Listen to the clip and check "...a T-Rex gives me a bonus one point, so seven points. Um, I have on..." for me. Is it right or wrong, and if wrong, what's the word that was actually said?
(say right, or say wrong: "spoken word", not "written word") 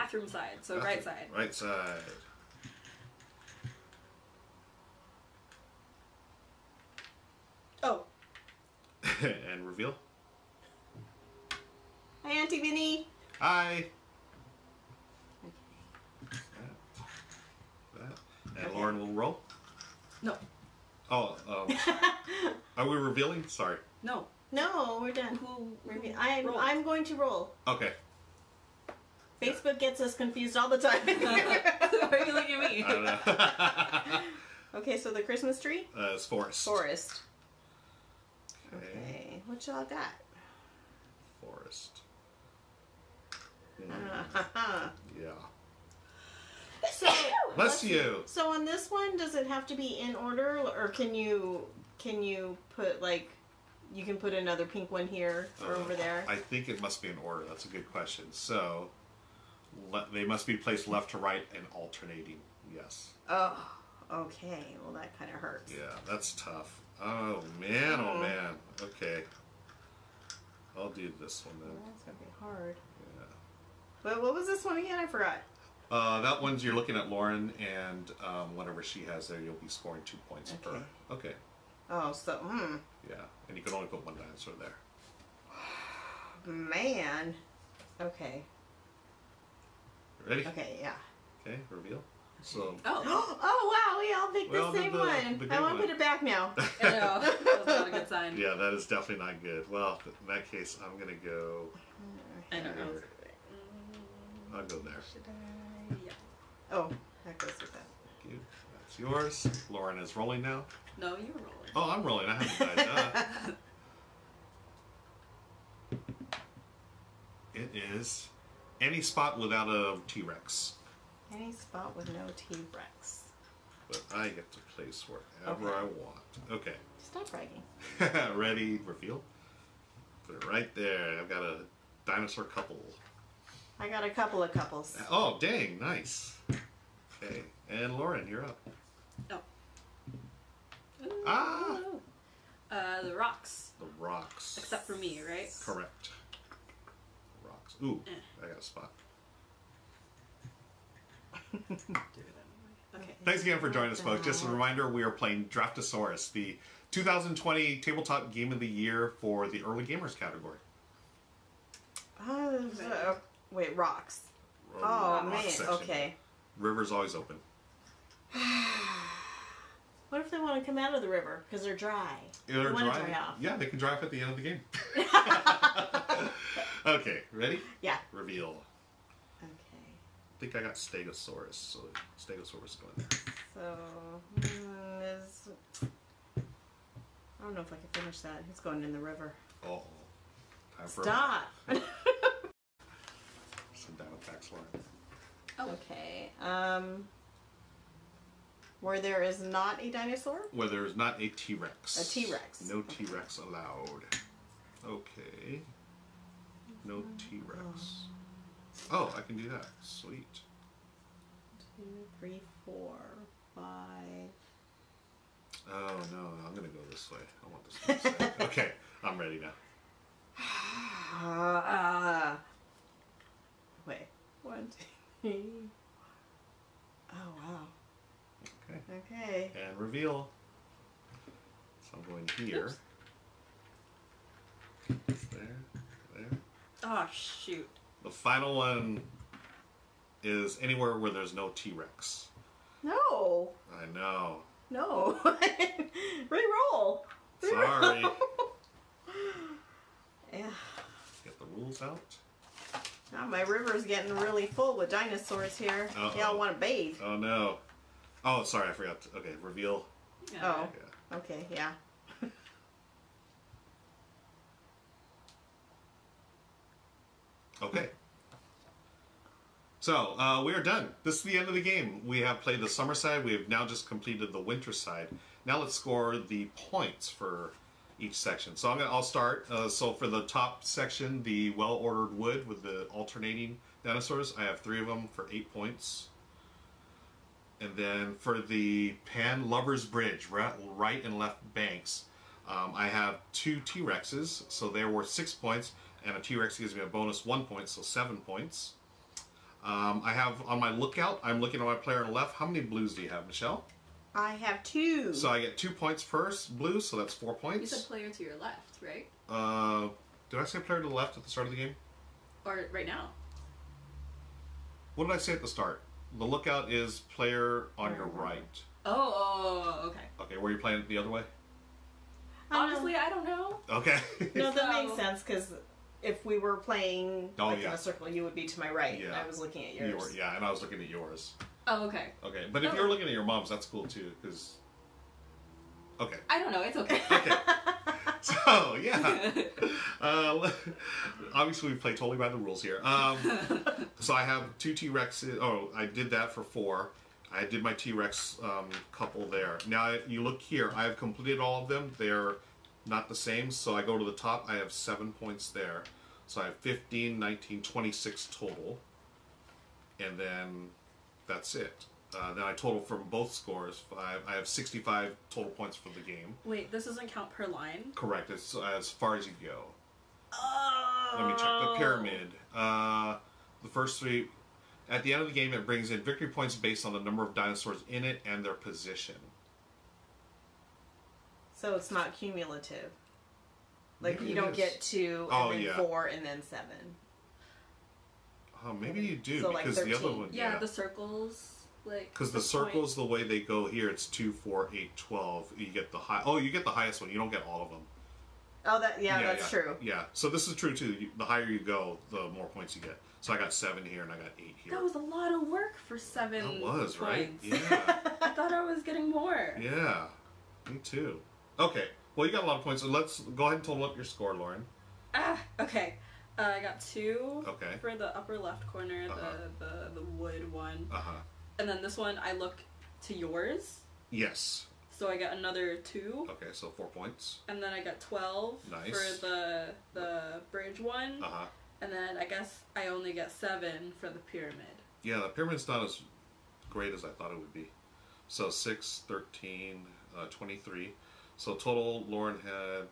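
right.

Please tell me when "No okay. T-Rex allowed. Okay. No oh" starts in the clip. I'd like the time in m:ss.
3:22.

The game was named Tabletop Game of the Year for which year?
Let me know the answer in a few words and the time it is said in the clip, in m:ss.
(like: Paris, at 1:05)
2020, at 2:36.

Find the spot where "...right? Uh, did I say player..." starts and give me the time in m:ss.
5:08.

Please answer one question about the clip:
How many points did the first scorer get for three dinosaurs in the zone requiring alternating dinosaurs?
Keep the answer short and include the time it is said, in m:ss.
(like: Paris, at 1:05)
8, at 4:45.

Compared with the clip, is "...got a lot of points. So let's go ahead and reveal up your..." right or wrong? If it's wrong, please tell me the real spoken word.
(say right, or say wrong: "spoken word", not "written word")
wrong: "total", not "reveal".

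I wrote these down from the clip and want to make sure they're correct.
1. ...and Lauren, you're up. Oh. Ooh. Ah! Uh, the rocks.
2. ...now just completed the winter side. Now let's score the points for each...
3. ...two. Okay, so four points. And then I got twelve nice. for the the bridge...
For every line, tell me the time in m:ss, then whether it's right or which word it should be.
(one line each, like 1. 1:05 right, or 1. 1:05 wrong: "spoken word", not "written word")
1. 2:17 right
2. 4:33 right
3. 7:05 right.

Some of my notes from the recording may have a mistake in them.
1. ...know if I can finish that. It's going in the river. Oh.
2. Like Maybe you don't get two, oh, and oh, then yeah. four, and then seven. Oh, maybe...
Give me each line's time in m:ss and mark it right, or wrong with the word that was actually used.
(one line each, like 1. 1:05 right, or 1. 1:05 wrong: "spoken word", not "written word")
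1. 3:07 right
2. 6:24 right.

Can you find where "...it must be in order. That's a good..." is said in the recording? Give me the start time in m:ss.
0:56.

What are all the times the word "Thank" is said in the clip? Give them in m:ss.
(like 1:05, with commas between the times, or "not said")
1:48, 2:33.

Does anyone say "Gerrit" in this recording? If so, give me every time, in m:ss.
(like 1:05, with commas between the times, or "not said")
not said.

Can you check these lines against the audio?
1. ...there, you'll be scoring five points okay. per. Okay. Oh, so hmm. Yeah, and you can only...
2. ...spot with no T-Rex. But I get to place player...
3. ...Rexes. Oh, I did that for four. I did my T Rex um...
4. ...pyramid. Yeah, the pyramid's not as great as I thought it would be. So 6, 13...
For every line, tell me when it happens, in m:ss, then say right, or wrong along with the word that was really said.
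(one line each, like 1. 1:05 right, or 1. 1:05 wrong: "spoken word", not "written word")
1. 1:19 wrong: "two", not "five"
2. 2:01 wrong: "wherever", not "player"
3. 5:44 right
4. 7:14 right.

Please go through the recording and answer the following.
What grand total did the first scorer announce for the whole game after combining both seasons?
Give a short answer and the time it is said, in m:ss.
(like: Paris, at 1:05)
65, at 6:04.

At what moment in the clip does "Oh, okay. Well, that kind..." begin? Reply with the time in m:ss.
1:03.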